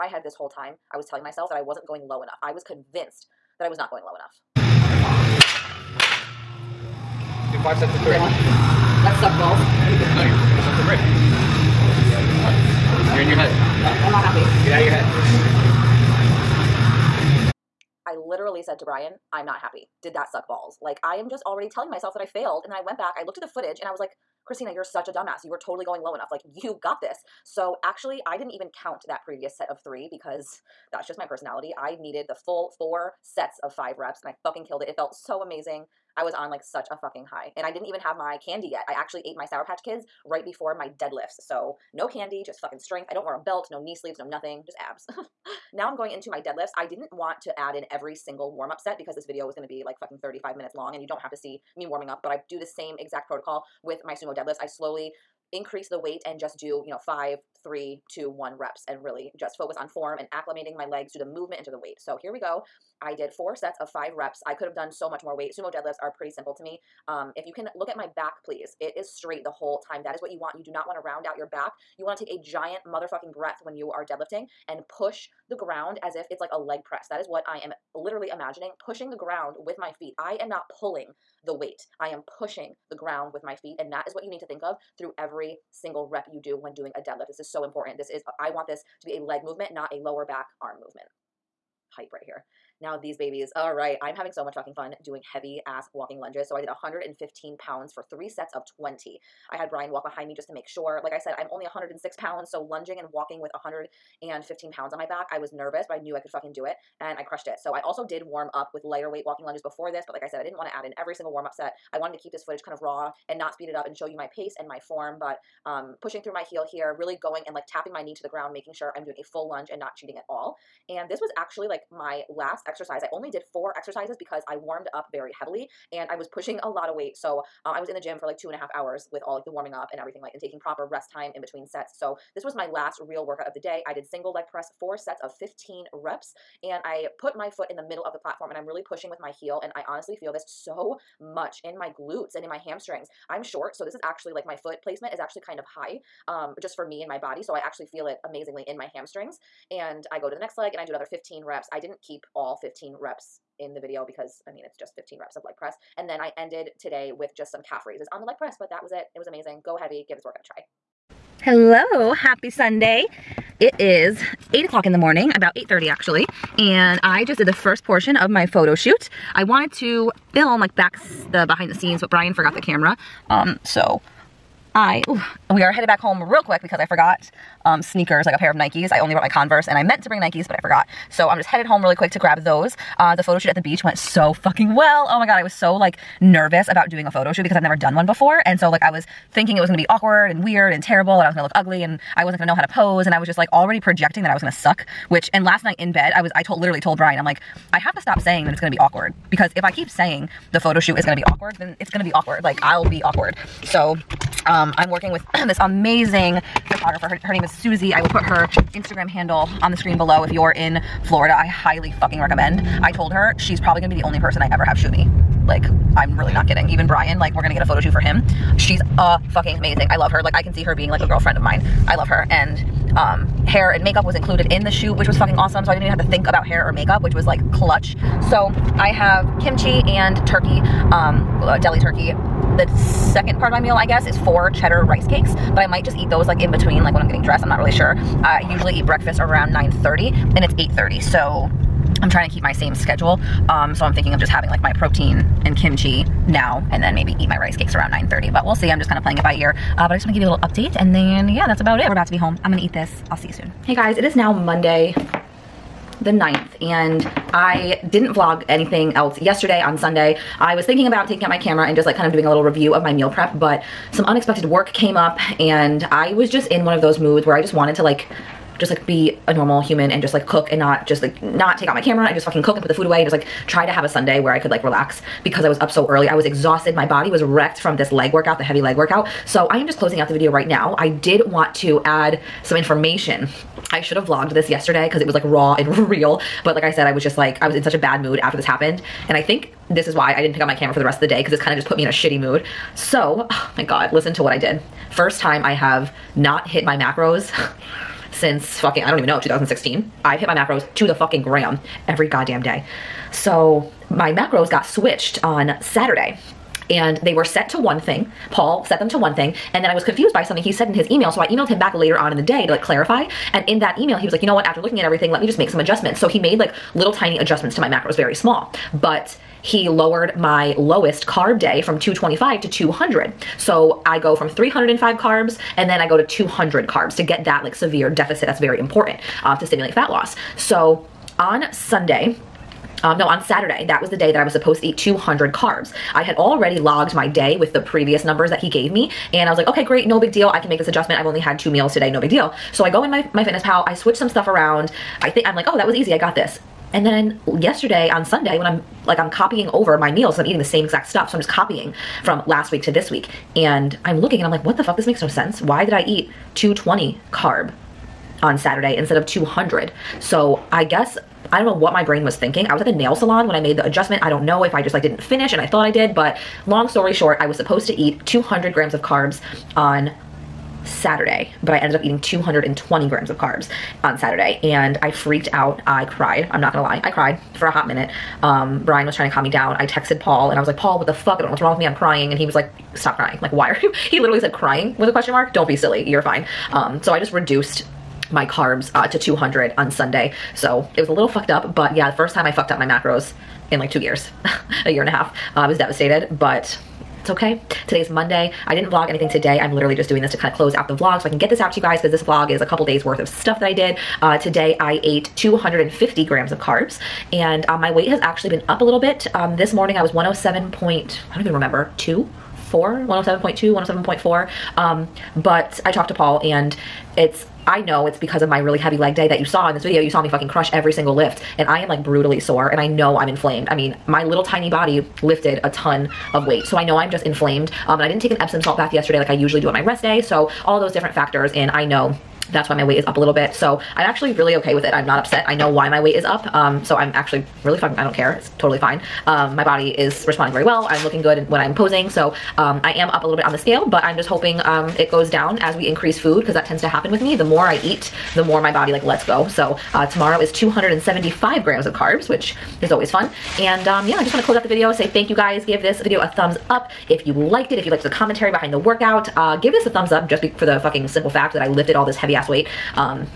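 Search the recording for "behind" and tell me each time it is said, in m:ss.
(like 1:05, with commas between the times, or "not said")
1:40, 2:51, 7:38.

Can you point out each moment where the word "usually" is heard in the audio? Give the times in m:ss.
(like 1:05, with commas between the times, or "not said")
3:58, 7:09.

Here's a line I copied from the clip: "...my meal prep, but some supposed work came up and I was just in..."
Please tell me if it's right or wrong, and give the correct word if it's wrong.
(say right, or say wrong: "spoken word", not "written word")
wrong: "unexpected", not "supposed".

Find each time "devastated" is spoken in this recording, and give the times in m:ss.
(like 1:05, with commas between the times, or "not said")
6:35.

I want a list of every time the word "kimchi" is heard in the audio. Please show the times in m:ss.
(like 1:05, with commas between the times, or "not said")
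3:49, 4:05.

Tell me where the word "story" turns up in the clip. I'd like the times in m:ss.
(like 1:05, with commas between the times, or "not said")
6:06.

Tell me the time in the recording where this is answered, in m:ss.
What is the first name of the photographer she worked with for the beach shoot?
3:27.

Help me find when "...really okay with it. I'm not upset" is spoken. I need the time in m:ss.
7:14.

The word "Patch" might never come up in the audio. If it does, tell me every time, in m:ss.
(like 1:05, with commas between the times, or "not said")
0:39.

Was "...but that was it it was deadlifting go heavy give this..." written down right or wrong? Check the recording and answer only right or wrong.
wrong.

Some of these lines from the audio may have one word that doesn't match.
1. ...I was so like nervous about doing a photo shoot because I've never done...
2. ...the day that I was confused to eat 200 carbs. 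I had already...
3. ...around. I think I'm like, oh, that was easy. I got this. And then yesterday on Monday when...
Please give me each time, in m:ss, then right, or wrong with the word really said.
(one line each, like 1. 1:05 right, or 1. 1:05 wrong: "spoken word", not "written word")
1. 3:05 right
2. 5:33 wrong: "supposed", not "confused"
3. 5:44 wrong: "Sunday", not "Monday".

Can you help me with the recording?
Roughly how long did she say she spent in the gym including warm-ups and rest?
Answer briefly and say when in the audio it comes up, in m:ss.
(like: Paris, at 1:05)
two and a half hours, at 2:08.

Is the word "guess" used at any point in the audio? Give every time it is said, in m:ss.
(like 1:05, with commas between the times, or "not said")
3:53, 6:00.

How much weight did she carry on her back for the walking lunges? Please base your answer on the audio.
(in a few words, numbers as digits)
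115 pounds.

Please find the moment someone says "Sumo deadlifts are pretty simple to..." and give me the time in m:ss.
1:05.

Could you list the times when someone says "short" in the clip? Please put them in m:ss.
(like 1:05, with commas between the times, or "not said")
2:23, 6:06.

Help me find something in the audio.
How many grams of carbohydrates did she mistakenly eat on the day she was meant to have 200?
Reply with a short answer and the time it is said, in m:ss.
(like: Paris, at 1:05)
220, at 6:12.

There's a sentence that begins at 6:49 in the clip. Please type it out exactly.
Um, this morning I was 107 point, I don't even remember, two?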